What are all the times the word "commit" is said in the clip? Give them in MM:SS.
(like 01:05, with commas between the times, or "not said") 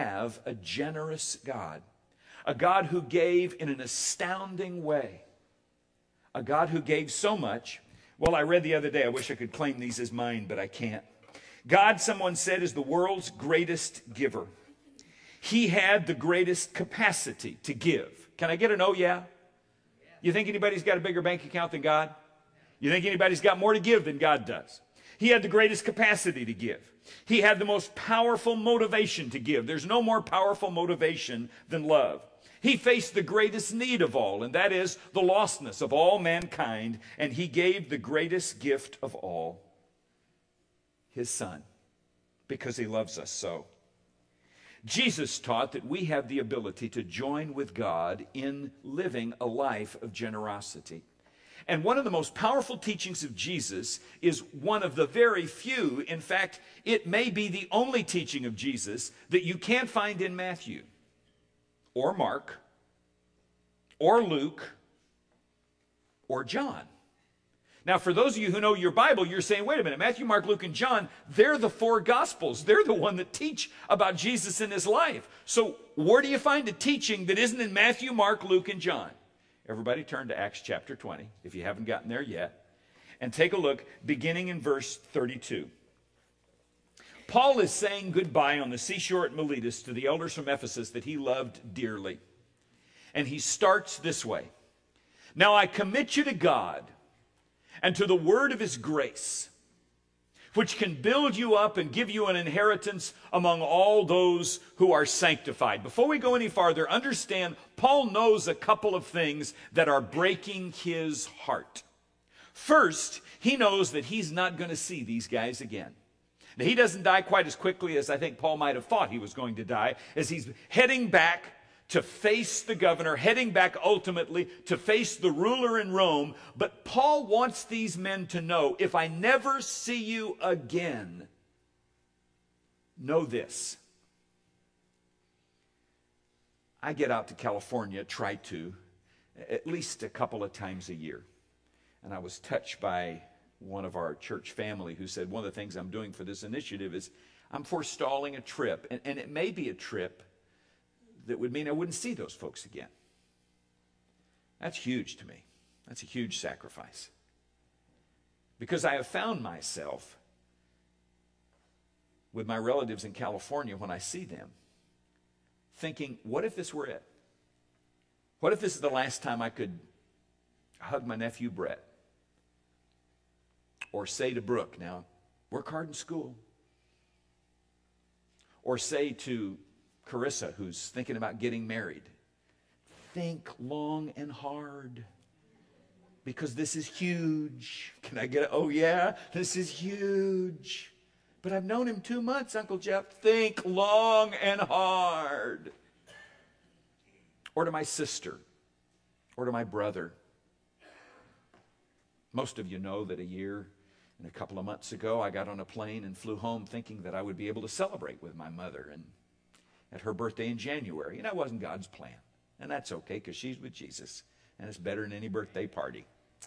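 01:35.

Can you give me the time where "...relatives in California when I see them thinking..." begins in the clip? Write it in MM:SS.
02:42.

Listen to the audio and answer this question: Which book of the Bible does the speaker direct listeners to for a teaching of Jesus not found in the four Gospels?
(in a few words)
Acts chapter 20.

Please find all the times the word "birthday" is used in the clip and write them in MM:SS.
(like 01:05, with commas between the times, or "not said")
03:30, 03:35.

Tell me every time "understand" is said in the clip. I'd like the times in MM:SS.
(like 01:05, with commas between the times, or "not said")
01:46.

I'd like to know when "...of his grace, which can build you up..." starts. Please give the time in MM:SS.
01:38.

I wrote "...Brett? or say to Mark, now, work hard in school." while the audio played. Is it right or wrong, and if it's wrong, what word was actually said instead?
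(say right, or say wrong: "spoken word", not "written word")
wrong: "Brooke", not "Mark".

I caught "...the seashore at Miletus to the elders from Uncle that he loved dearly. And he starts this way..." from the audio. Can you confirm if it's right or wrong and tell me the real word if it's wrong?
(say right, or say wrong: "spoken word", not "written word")
wrong: "Ephesus", not "Uncle".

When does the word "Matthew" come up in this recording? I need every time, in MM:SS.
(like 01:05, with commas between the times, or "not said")
01:00, 01:09, 01:17.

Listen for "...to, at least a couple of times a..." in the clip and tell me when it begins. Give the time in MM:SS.
02:18.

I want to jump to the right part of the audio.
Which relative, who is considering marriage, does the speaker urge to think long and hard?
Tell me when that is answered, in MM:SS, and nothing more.
03:00.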